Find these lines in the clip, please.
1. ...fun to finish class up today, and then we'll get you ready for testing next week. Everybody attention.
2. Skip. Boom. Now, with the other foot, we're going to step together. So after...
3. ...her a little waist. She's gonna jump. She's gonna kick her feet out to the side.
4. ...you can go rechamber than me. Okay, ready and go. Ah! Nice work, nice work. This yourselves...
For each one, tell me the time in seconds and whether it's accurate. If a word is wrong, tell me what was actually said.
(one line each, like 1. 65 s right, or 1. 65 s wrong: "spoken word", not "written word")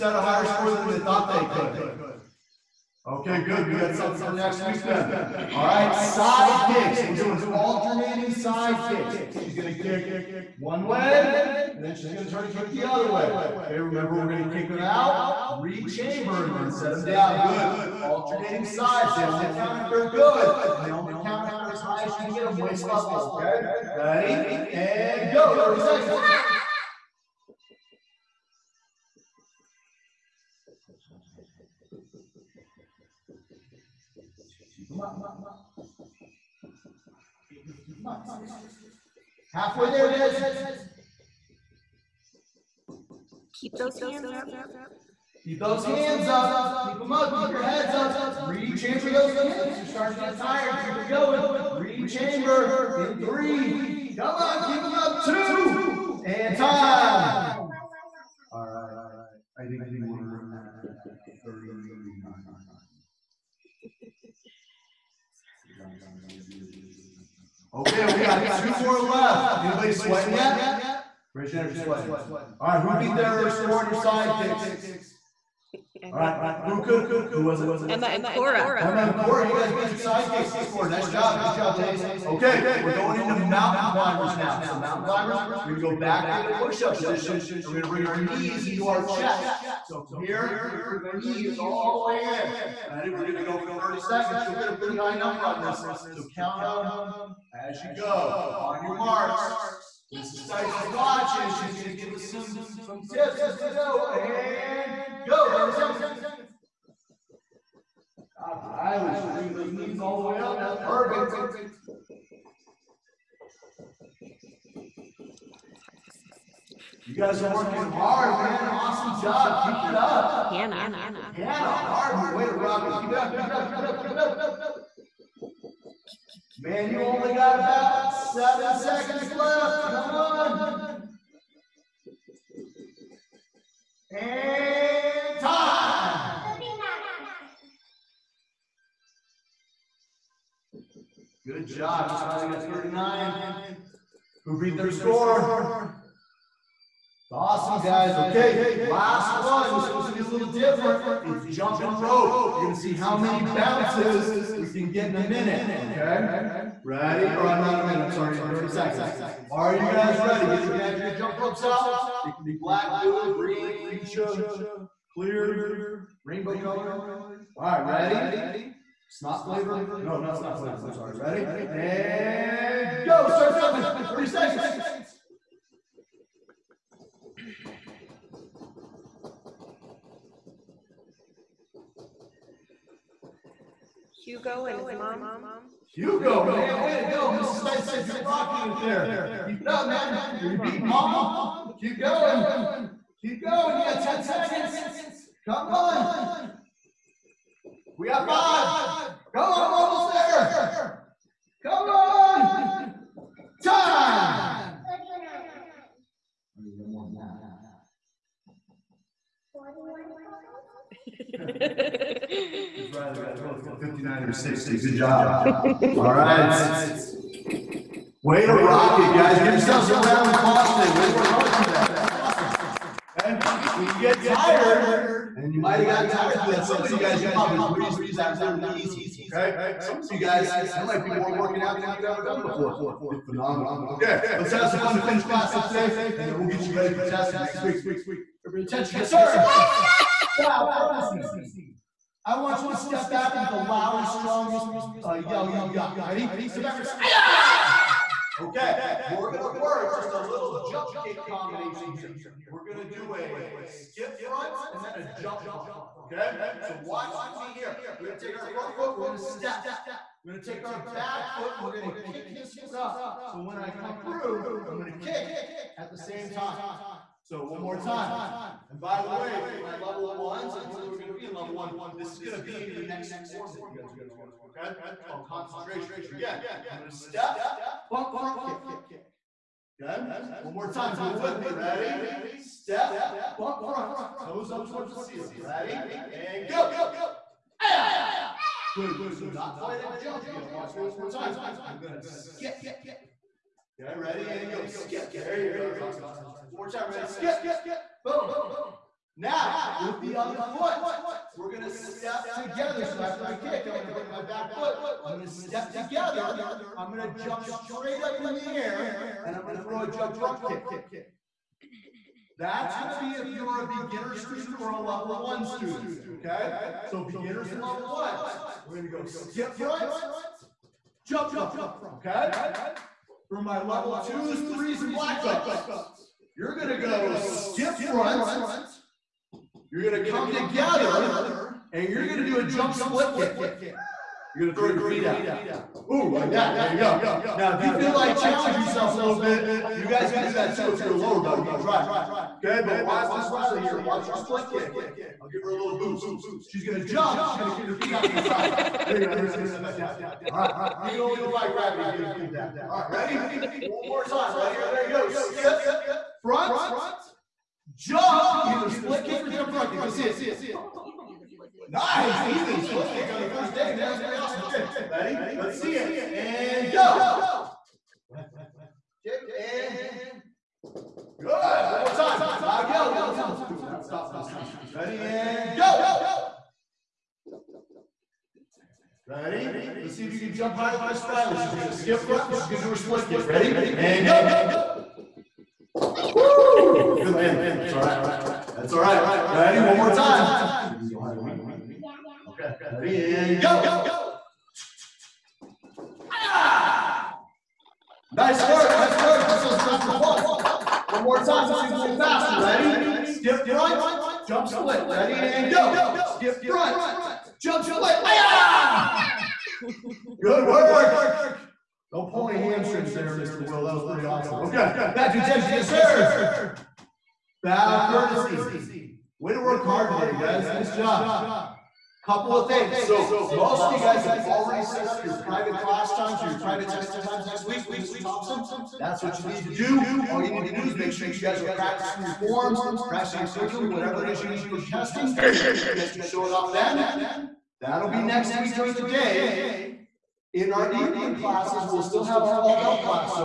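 1. 234 s right
2. 297 s right
3. 345 s wrong: "boost", not "waist"
4. 390 s wrong: "higher", not "rechamber".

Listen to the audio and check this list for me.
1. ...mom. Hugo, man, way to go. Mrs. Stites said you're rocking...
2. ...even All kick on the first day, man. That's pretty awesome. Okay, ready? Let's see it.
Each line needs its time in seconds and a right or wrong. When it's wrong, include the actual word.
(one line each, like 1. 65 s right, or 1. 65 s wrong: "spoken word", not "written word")
1. 184 s right
2. 362 s wrong: "Split", not "All".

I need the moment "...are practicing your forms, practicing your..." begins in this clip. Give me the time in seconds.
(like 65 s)
431 s.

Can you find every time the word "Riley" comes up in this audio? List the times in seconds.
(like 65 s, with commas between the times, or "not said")
108 s, 212 s, 343 s, 381 s.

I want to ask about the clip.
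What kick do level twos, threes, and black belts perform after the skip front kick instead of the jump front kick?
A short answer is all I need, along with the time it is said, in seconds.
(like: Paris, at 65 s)
jump split kick, at 332 s.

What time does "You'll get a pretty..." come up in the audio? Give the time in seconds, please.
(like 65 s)
94 s.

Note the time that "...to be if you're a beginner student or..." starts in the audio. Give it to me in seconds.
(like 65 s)
312 s.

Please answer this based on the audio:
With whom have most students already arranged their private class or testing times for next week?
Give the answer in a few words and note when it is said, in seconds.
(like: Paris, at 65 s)
Mr. Thompson, at 427 s.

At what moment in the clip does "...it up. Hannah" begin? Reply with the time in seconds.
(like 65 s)
119 s.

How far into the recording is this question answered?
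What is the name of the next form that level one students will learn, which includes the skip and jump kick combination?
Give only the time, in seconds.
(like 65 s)
275 s.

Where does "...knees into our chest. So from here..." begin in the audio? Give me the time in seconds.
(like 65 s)
88 s.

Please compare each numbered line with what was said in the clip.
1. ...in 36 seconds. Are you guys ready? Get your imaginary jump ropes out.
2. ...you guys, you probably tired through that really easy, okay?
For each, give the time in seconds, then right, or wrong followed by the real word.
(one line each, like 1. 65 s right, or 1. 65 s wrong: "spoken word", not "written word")
1. 158 s wrong: "30", not "36"
2. 226 s wrong: "breezed", not "tired".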